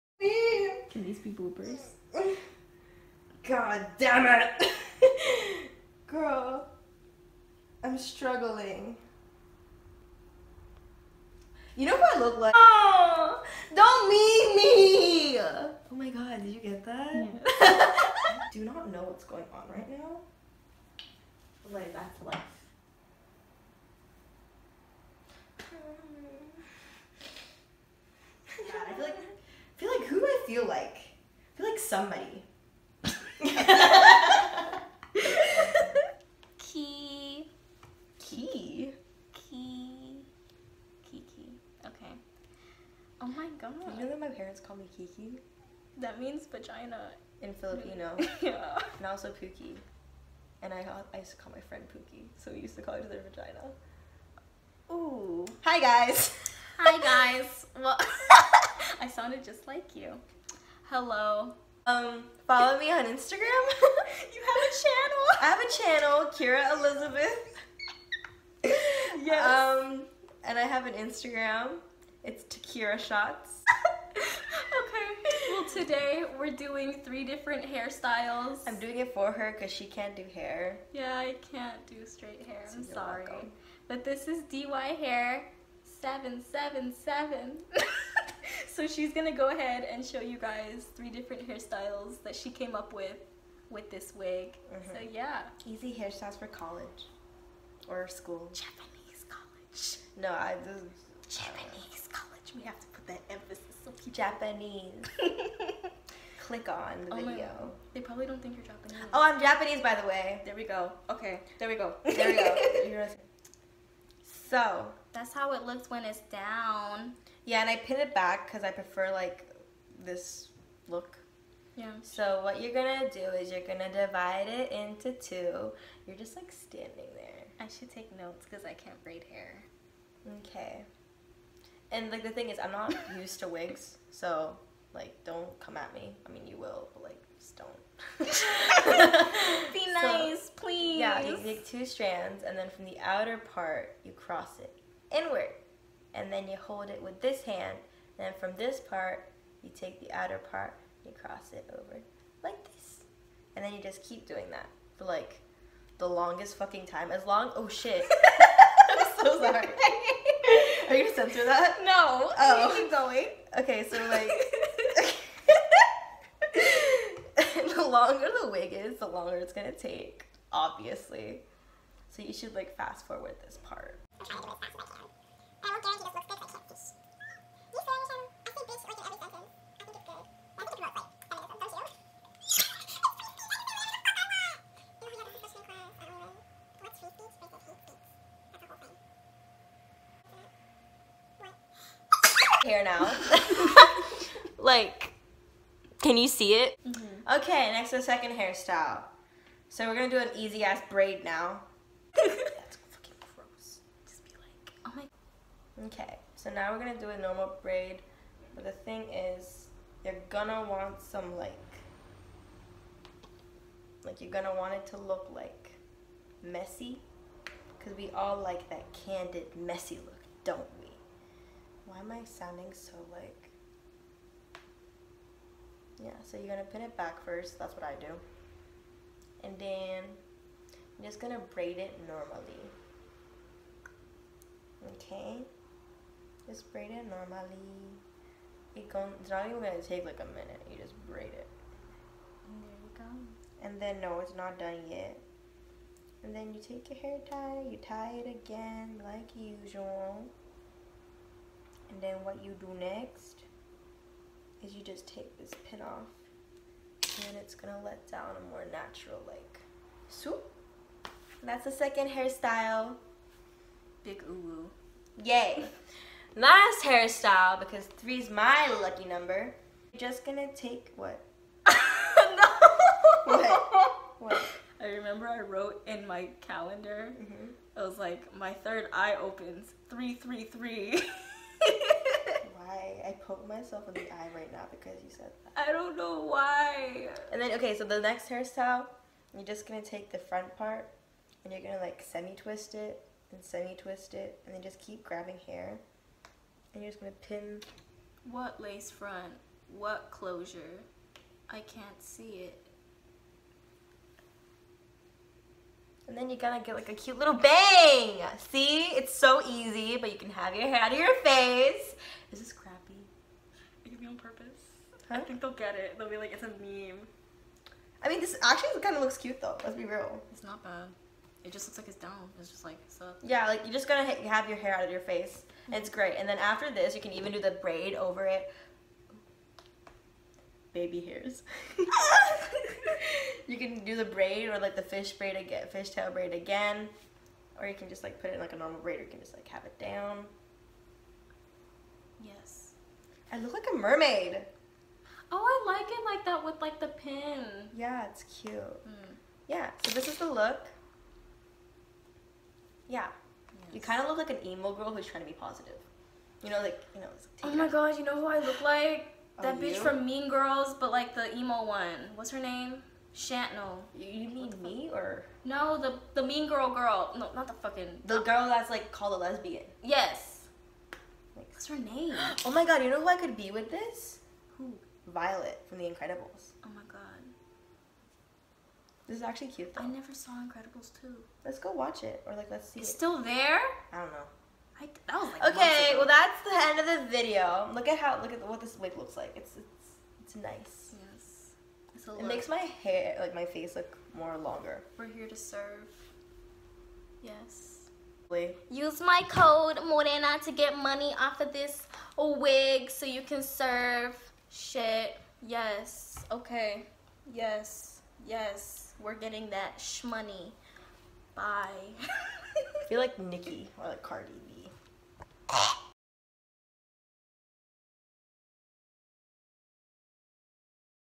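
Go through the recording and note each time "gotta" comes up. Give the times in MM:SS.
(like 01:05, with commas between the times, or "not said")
05:06, 05:23.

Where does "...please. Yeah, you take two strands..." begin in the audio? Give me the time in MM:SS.
02:20.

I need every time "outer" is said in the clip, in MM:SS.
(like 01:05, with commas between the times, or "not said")
02:22, 02:30.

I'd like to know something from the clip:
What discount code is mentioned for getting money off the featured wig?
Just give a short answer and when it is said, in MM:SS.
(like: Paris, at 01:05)
Morena, at 06:39.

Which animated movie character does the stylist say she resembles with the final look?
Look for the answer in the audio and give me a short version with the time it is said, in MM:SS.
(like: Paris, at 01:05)
Violet, at 06:15.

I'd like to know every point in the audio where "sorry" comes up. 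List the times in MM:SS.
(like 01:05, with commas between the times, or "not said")
01:22, 02:39.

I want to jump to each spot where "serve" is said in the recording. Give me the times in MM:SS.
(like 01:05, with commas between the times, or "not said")
06:35, 06:43.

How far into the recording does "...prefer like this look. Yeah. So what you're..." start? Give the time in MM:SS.
01:58.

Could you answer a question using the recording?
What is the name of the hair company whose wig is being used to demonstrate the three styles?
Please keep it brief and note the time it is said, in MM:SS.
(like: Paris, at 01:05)
DY Hair 777, at 01:24.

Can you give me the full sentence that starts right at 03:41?
Why am I sounding so like, yeah, so you're gonna pin it back first, that's what I do.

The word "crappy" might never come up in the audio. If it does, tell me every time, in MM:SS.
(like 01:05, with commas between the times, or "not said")
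05:12.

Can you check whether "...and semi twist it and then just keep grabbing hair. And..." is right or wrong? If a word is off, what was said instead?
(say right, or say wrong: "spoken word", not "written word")
right.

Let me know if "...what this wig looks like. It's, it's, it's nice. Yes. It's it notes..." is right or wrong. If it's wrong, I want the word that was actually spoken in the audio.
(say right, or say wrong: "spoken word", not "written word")
wrong: "makes", not "notes".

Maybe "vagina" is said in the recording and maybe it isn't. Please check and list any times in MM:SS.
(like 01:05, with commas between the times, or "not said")
00:46, 00:53.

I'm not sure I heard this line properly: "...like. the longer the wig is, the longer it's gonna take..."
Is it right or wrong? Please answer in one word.
right.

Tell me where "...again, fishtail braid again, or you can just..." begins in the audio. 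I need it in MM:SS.
05:35.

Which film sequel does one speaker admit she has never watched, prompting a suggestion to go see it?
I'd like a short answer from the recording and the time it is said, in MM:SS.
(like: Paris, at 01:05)
Incredibles 2, at 06:20.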